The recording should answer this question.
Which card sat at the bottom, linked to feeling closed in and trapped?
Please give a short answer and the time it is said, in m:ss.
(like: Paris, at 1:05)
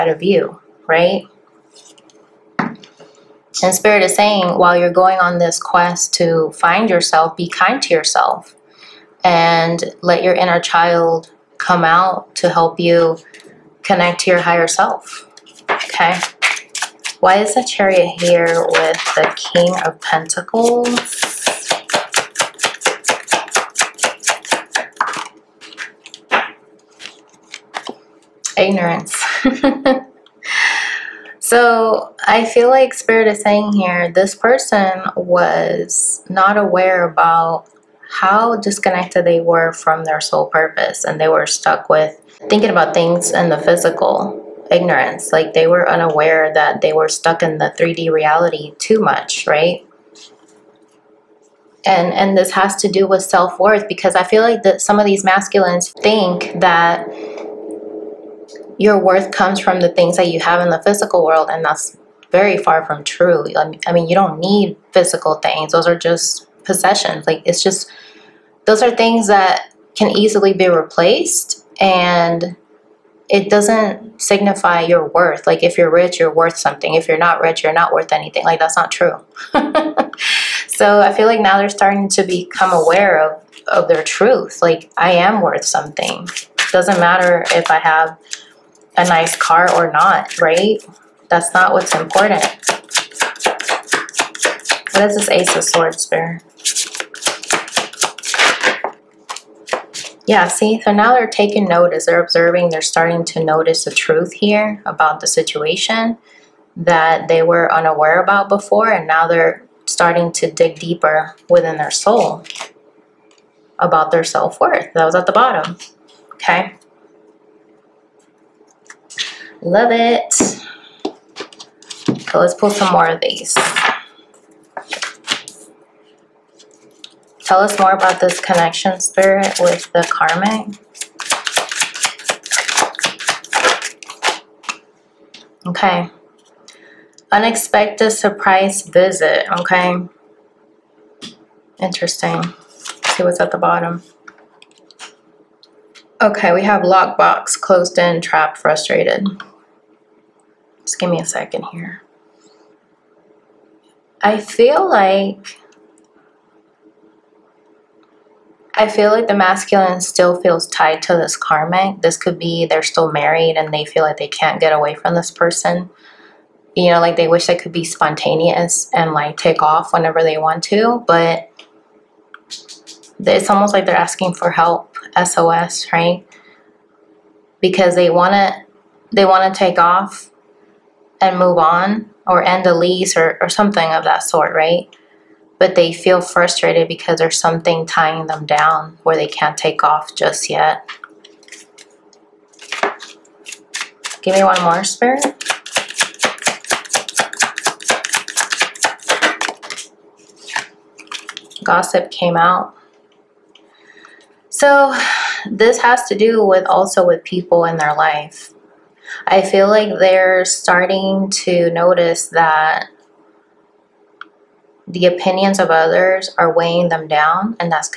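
Lockbox, at 2:26.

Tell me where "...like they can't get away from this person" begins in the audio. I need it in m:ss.
2:44.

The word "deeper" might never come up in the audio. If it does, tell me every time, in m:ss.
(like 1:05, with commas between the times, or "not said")
1:50.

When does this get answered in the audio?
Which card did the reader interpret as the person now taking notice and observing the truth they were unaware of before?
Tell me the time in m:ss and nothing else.
1:35.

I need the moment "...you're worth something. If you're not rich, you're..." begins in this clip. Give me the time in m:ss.
1:16.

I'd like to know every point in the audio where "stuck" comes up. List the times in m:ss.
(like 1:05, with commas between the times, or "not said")
0:41, 0:47.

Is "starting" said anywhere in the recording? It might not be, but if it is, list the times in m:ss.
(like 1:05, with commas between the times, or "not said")
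1:21, 1:42, 1:49, 3:30.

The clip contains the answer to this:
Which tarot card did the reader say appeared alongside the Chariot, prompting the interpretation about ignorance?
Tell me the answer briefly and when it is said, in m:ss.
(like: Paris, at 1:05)
King of Pentacles, at 0:19.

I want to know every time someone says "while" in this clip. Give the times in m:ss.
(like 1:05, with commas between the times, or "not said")
0:04.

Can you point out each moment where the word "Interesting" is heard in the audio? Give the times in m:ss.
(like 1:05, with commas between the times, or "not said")
2:21.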